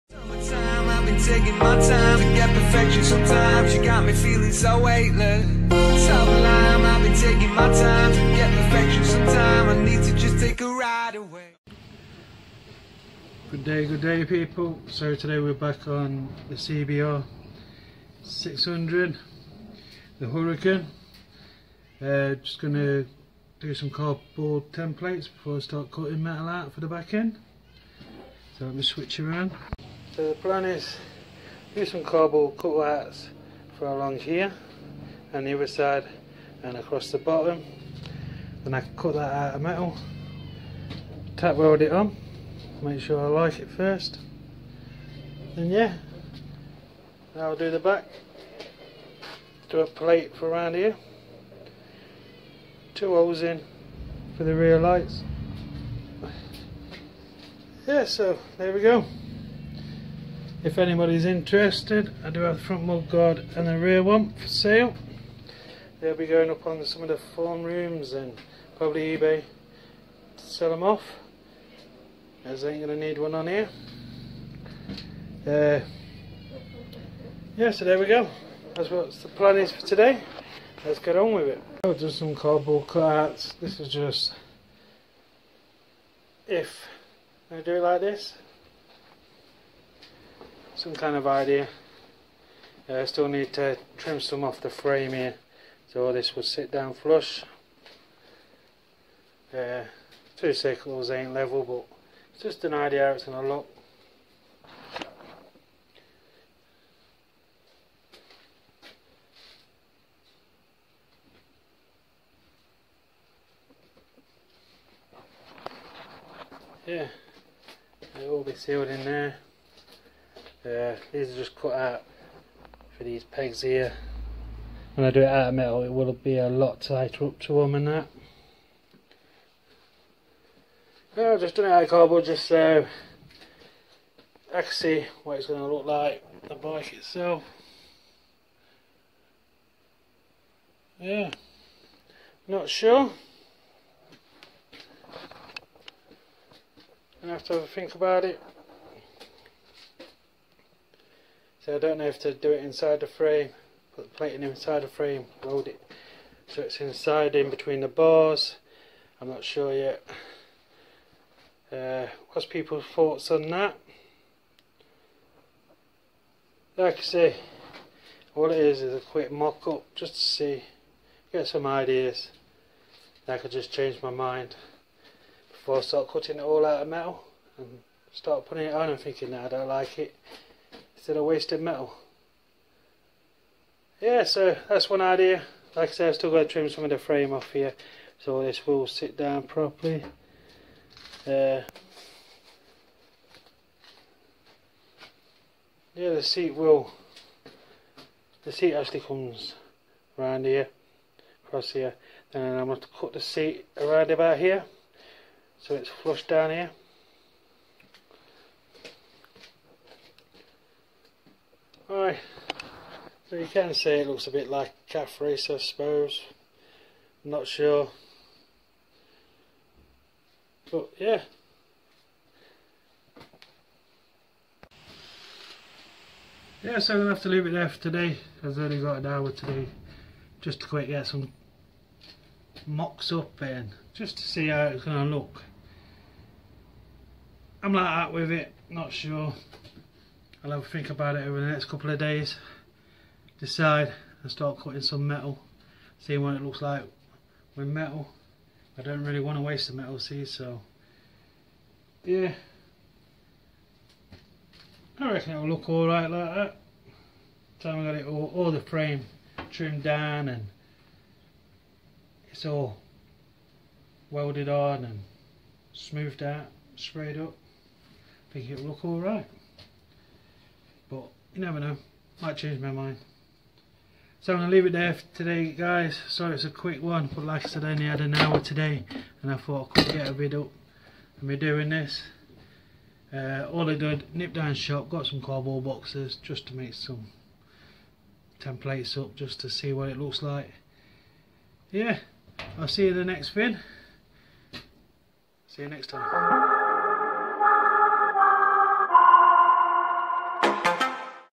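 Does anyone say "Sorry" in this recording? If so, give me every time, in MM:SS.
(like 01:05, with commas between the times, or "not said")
04:36.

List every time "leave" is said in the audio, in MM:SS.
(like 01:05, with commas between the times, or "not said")
03:47, 04:34.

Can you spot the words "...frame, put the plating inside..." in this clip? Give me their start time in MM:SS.
02:33.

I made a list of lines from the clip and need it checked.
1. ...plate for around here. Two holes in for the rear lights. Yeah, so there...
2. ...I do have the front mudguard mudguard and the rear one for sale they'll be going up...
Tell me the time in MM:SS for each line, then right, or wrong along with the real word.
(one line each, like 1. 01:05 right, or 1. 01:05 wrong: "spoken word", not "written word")
1. 00:49 right
2. 01:02 wrong: "guard", not "mudguard".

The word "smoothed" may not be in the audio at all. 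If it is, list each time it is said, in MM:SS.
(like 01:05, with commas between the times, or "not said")
04:25.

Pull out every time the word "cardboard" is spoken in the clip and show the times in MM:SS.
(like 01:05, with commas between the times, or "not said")
00:23, 00:32, 01:22, 02:11, 04:45.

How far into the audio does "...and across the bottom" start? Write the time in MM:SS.
00:36.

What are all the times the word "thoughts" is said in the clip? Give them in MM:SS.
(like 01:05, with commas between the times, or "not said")
02:42, 04:39.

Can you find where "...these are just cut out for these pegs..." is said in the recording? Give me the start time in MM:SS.
02:01.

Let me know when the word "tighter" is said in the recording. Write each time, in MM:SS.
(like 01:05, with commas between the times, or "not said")
02:06.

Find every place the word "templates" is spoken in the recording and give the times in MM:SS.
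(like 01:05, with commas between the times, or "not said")
00:24, 04:48.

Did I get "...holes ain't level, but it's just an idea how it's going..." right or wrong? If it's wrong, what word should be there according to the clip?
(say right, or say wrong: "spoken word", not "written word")
wrong: "circles", not "holes".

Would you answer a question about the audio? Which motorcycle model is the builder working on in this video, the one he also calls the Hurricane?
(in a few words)
CBR 600.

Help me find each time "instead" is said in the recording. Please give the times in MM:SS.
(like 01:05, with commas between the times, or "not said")
03:00.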